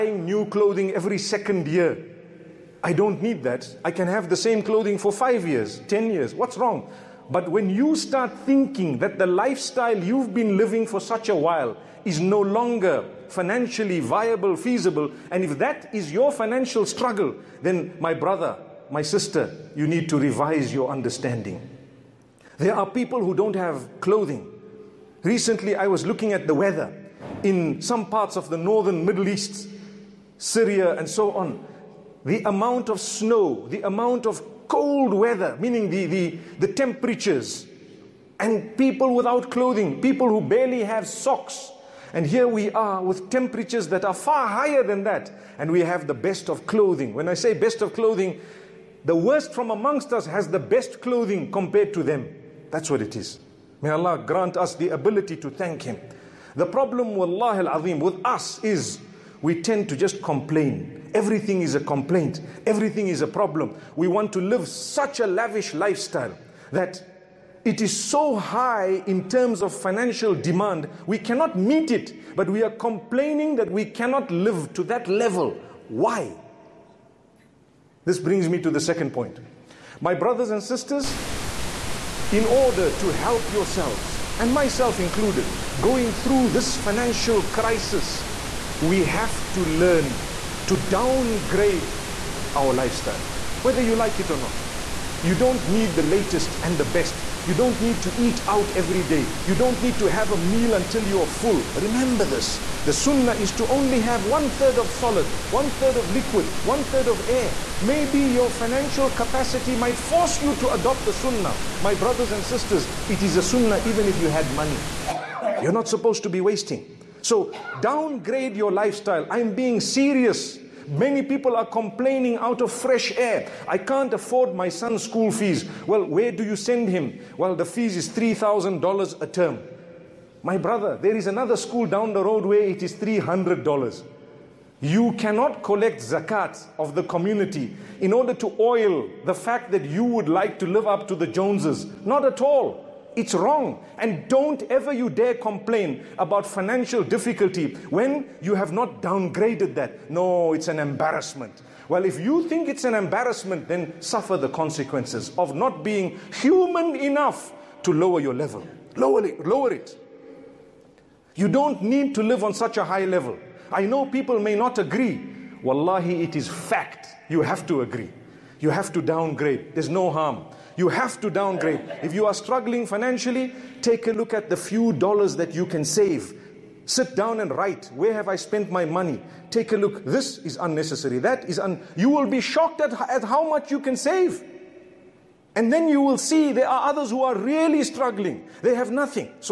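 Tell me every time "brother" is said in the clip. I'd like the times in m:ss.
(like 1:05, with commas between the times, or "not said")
0:18, 1:20, 1:51, 2:10.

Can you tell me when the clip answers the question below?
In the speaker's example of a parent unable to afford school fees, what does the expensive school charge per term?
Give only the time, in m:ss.
2:08.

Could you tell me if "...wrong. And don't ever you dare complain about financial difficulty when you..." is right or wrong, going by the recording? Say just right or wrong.
right.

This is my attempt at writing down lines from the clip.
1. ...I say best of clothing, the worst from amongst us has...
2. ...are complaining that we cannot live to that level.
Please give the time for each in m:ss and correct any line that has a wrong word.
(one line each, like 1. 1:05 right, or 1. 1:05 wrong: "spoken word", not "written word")
1. 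0:47 right
2. 1:12 right.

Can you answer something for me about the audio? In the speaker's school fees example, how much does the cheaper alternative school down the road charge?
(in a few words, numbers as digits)
$300.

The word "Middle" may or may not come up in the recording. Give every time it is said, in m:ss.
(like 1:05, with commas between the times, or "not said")
0:29.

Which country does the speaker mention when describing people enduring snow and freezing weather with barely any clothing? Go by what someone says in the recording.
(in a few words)
Syria.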